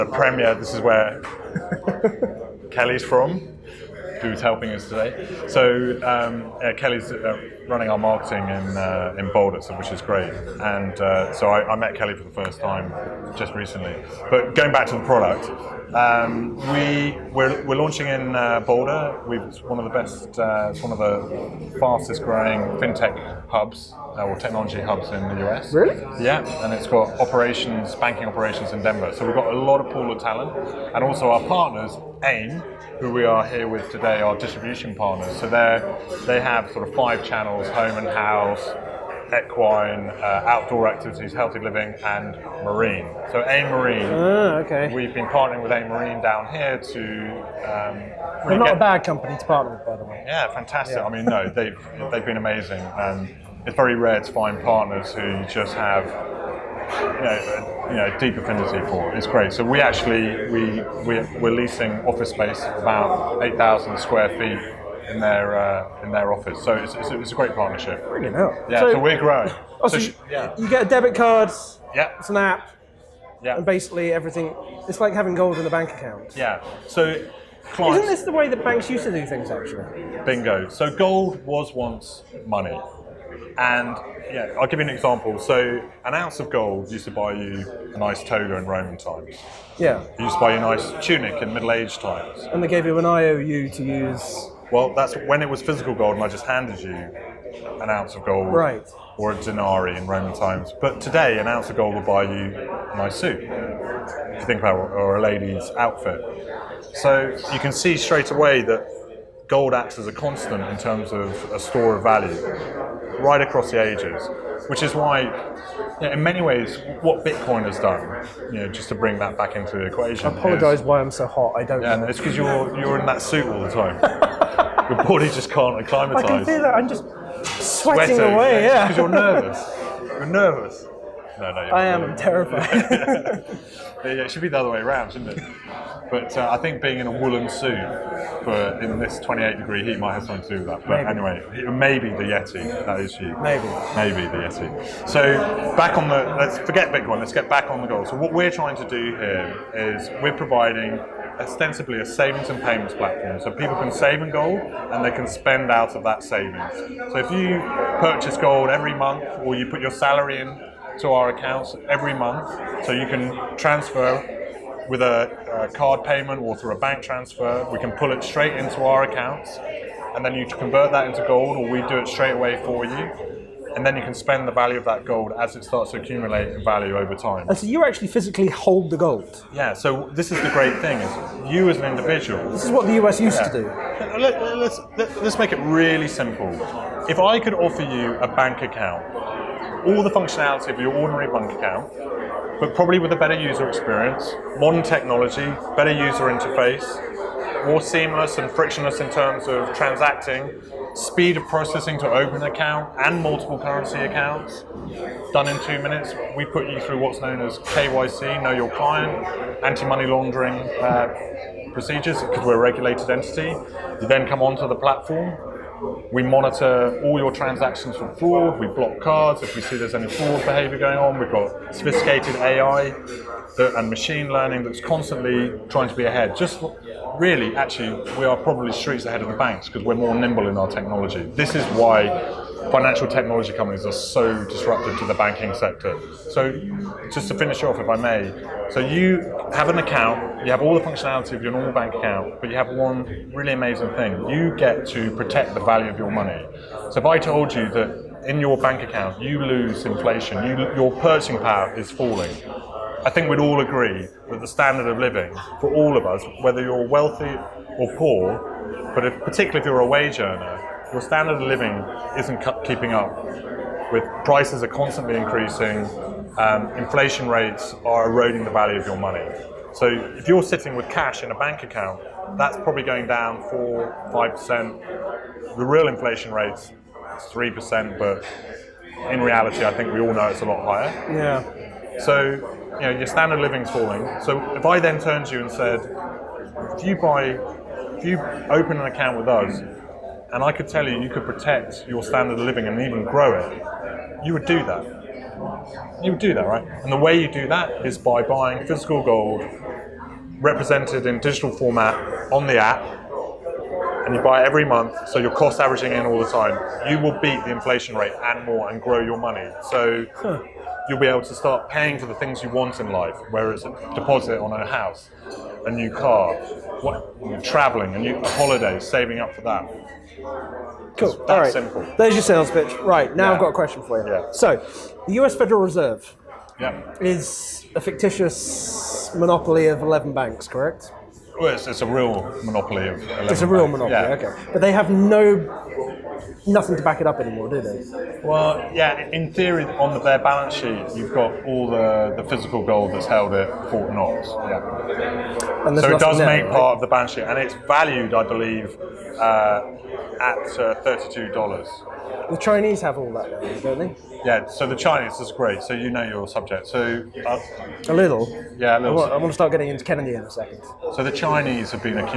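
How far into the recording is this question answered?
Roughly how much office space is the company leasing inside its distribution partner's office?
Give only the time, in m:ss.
1:03.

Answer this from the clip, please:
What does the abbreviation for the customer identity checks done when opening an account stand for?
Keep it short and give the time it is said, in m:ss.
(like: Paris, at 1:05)
Know your client, at 3:28.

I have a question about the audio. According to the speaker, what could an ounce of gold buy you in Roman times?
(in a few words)
A nice toga.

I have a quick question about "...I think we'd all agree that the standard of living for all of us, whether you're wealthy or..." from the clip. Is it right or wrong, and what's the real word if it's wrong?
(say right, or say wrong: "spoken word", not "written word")
right.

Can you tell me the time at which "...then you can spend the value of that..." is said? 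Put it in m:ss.
2:53.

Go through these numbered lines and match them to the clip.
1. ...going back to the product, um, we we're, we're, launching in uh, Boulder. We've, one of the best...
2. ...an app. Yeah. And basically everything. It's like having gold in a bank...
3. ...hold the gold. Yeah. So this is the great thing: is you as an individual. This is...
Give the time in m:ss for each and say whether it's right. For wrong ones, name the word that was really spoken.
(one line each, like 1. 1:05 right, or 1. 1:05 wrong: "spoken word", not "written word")
1. 0:14 right
2. 1:12 right
3. 2:58 right.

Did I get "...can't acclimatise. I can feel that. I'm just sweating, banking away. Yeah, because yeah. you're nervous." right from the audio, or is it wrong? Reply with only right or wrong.
wrong.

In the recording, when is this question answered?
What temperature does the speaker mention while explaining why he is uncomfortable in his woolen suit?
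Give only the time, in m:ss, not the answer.
2:19.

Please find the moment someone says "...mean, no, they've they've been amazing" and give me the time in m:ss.
0:51.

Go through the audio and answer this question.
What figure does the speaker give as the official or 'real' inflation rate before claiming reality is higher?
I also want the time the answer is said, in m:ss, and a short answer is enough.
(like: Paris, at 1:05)
3 percent, at 4:37.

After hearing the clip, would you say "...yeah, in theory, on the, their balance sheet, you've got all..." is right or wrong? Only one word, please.
right.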